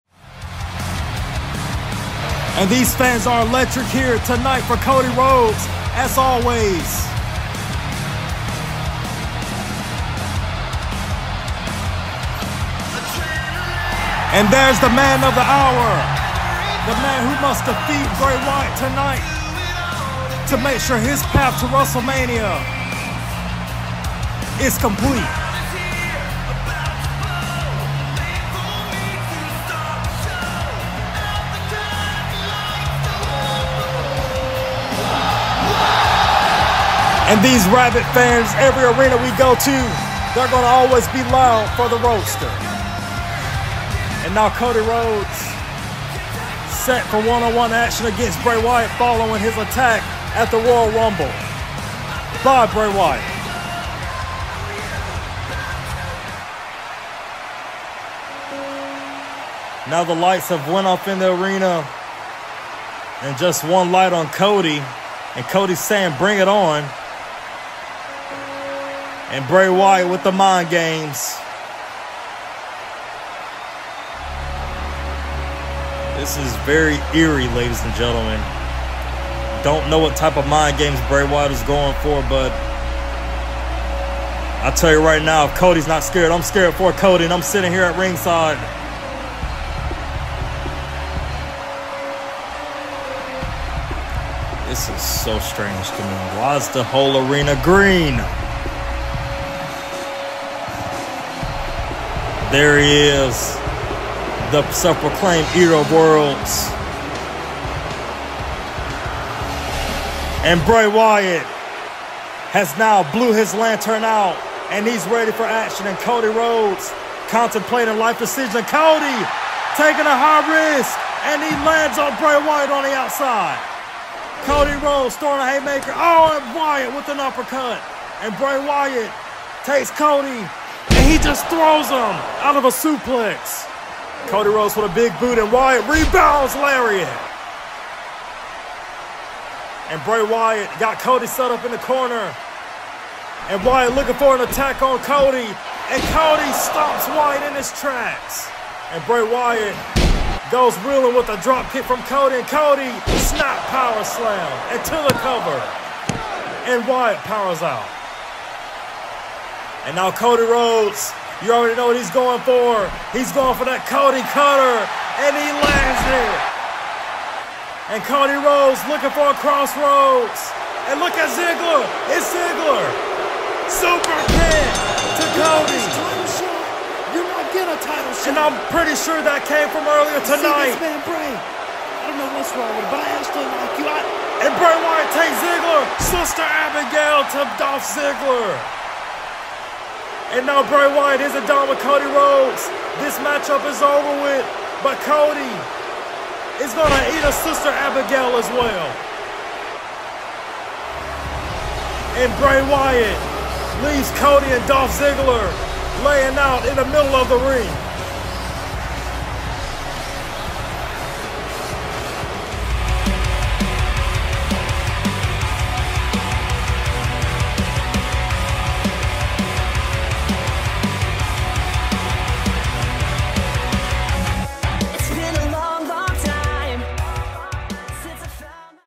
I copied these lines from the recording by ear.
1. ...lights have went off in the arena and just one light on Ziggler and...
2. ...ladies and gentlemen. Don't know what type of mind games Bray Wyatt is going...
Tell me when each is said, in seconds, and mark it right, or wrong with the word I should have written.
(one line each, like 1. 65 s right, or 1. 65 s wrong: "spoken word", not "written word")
1. 60 s wrong: "Cody", not "Ziggler"
2. 77 s right.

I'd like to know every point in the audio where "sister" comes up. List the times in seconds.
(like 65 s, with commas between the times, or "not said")
186 s, 197 s.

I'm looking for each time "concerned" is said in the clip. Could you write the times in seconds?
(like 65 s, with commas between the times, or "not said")
not said.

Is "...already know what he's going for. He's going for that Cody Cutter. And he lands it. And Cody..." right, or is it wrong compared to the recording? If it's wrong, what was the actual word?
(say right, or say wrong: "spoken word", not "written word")
right.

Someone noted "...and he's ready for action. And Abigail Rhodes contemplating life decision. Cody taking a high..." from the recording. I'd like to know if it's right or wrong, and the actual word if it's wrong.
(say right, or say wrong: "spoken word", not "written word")
wrong: "Cody", not "Abigail".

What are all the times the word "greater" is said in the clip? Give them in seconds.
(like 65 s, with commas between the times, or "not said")
not said.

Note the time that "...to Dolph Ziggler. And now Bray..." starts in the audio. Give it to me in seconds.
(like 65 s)
187 s.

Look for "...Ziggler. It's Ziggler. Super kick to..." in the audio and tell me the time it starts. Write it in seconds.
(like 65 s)
171 s.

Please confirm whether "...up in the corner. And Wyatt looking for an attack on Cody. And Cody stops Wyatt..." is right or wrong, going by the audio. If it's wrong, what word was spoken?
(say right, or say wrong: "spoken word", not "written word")
right.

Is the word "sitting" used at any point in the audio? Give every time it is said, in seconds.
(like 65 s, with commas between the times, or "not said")
87 s.